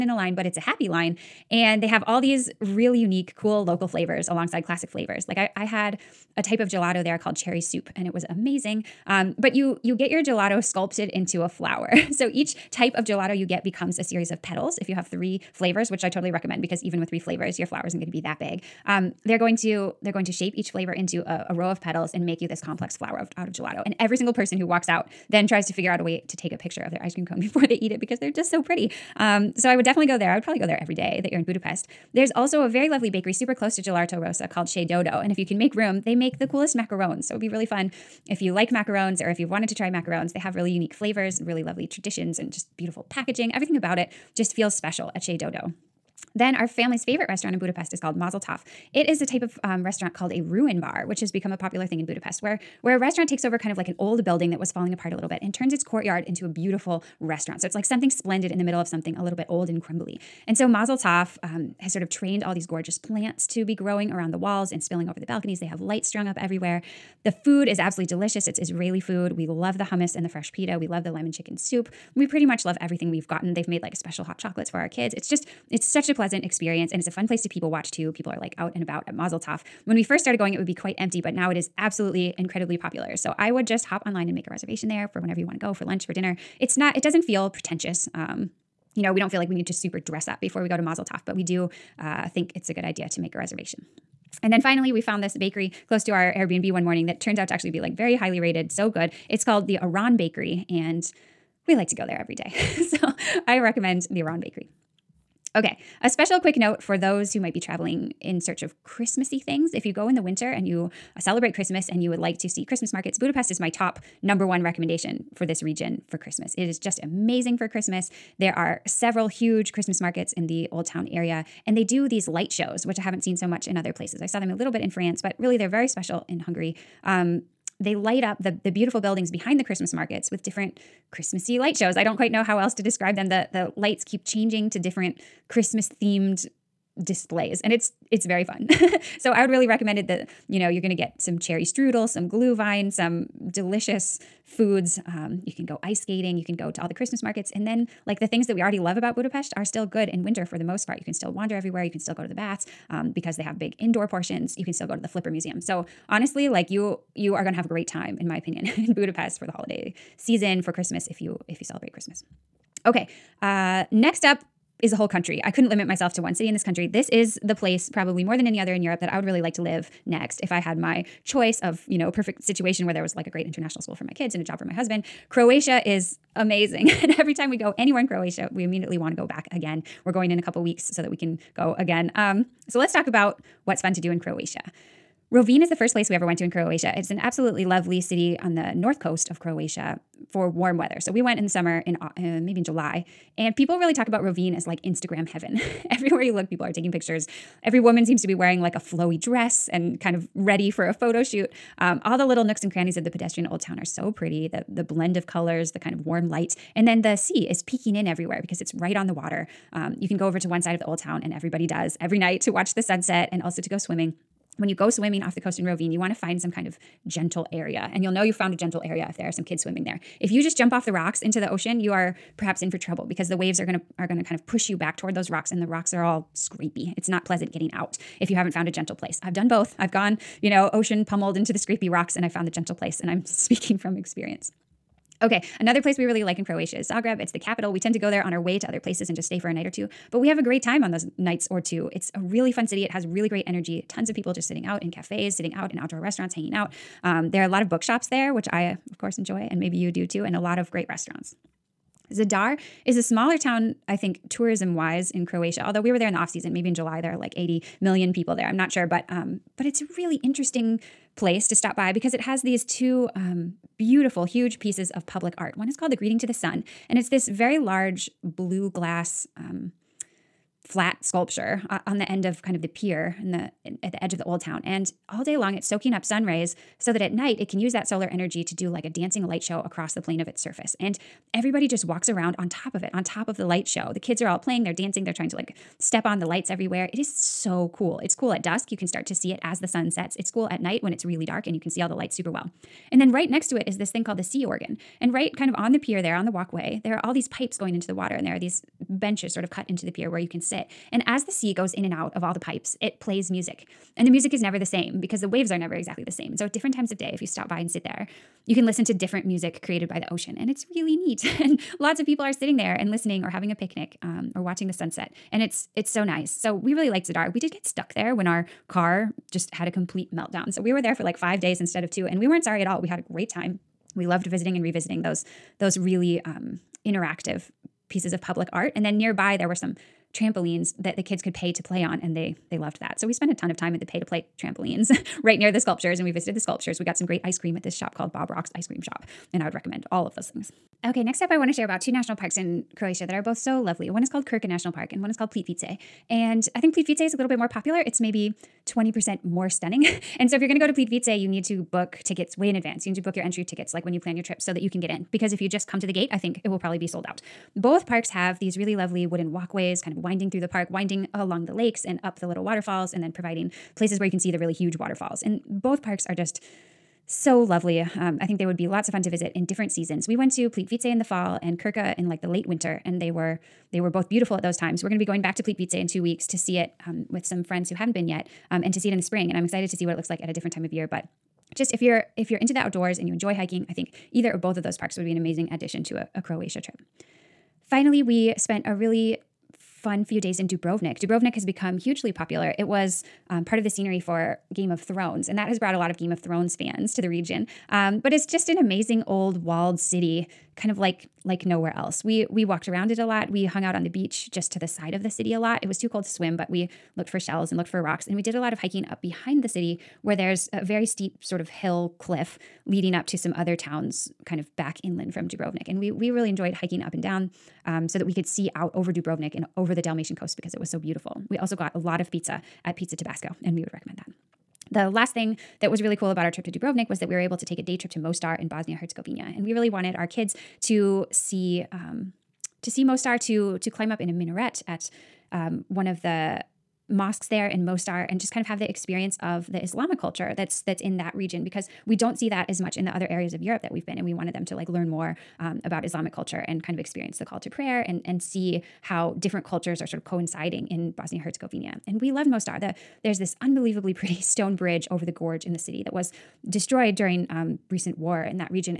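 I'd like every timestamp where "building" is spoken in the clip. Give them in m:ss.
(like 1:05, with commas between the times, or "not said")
0:54, 2:08.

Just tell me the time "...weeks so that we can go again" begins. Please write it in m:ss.
3:00.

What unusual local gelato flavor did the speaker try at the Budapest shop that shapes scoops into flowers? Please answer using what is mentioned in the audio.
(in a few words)
Cherry soup.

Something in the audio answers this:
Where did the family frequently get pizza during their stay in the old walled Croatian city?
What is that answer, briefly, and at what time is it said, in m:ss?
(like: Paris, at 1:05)
Pizza Tabasco, at 7:02.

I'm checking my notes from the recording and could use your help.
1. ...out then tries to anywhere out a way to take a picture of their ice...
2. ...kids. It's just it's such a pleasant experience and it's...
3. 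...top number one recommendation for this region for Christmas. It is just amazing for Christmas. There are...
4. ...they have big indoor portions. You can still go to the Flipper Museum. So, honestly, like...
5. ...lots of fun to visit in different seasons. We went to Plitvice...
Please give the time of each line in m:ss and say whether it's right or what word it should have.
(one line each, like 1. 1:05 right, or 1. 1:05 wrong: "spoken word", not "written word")
1. 0:24 wrong: "figure", not "anywhere"
2. 1:14 right
3. 1:53 right
4. 2:33 right
5. 6:08 right.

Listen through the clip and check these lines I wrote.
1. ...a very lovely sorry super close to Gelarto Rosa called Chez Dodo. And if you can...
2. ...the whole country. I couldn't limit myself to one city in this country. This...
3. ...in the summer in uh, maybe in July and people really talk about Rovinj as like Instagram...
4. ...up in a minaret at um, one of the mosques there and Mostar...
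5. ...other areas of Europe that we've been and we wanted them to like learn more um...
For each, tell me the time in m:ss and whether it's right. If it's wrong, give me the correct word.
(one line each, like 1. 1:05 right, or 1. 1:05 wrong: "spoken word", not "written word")
1. 0:32 wrong: "bakery", not "sorry"
2. 2:44 right
3. 3:11 right
4. 7:13 right
5. 7:22 right.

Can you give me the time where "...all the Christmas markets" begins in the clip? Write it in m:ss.
2:26.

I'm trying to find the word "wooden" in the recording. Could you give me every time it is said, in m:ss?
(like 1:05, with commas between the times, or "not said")
5:59.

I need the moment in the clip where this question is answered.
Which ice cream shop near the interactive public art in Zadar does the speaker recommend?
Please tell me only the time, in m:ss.
5:38.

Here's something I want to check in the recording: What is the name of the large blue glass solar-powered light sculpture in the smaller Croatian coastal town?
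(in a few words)
The Greeting to the Sun.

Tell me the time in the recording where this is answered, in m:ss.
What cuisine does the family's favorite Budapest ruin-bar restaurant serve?
1:08.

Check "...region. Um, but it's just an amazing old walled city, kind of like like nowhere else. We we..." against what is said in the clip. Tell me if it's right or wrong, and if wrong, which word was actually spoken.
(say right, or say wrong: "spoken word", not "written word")
right.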